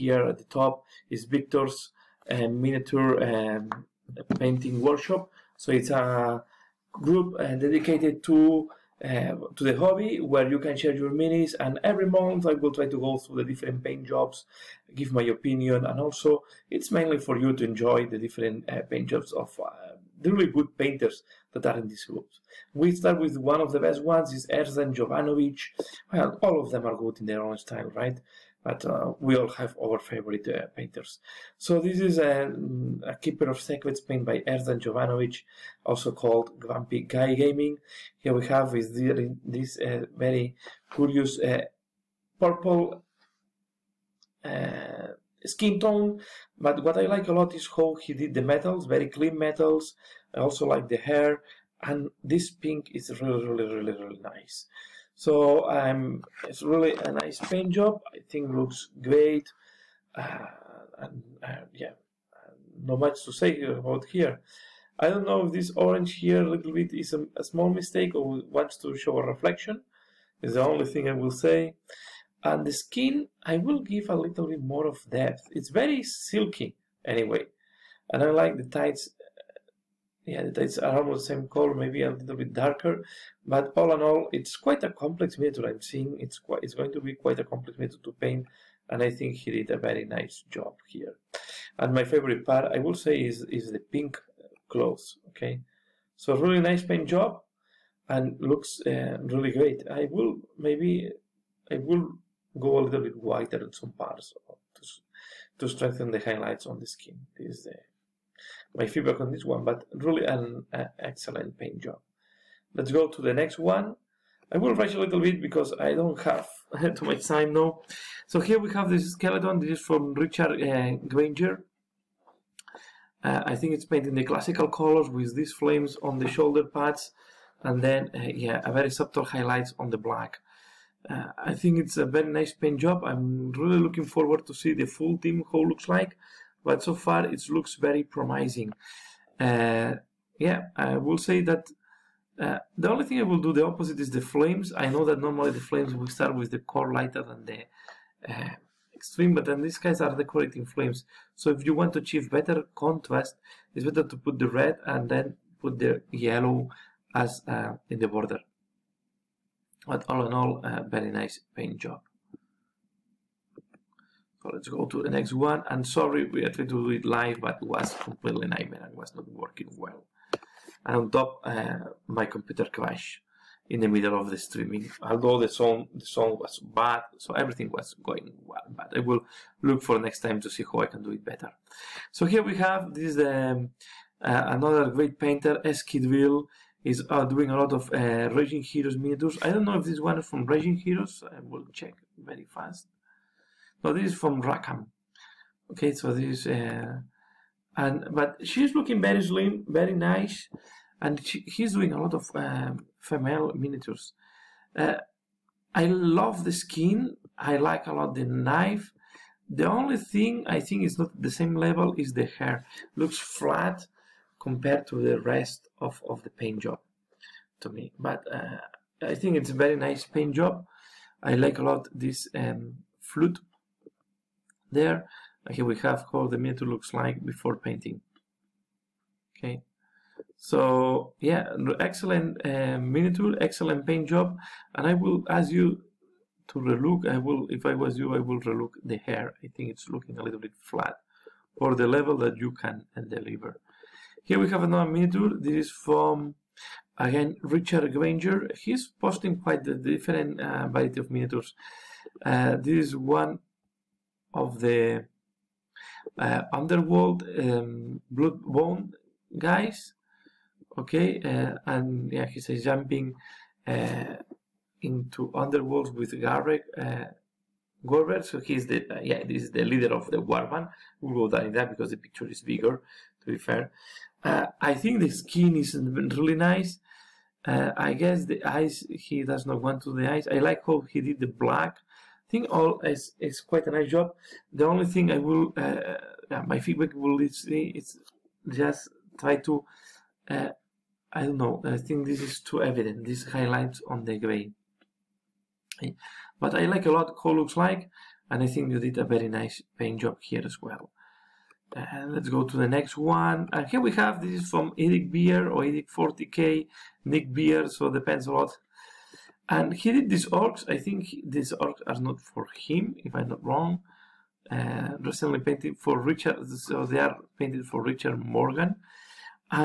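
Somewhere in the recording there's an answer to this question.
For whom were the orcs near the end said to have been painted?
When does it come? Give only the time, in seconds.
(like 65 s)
317 s.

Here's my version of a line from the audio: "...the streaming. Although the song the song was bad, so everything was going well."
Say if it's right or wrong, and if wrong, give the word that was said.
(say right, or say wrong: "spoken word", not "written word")
right.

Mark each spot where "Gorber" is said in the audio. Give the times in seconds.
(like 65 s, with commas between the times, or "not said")
267 s.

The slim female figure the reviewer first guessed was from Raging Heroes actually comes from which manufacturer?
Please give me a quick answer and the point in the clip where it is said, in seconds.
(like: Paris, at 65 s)
Rackham, at 194 s.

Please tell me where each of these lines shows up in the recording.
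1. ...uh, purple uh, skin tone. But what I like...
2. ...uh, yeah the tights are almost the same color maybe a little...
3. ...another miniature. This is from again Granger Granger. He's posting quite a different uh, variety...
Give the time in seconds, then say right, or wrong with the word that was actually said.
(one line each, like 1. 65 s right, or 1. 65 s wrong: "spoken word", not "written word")
1. 41 s right
2. 79 s right
3. 244 s wrong: "Richard", not "Granger".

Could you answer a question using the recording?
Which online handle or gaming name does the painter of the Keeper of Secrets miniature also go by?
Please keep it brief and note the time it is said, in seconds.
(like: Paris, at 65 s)
Grumpy Guy Gaming, at 36 s.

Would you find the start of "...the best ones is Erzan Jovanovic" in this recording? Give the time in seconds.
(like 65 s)
23 s.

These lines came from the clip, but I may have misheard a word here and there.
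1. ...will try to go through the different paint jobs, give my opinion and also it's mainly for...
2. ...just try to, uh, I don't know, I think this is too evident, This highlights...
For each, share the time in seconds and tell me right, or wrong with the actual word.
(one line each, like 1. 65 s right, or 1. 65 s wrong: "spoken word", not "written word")
1. 12 s right
2. 288 s right.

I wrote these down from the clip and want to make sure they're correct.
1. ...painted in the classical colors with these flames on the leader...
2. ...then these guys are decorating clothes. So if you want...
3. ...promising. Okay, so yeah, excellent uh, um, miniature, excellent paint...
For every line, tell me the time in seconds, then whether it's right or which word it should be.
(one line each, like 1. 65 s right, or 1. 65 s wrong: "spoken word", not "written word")
1. 123 s wrong: "shoulder", not "leader"
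2. 149 s wrong: "flames", not "clothes"
3. 227 s wrong: "painting", not "promising".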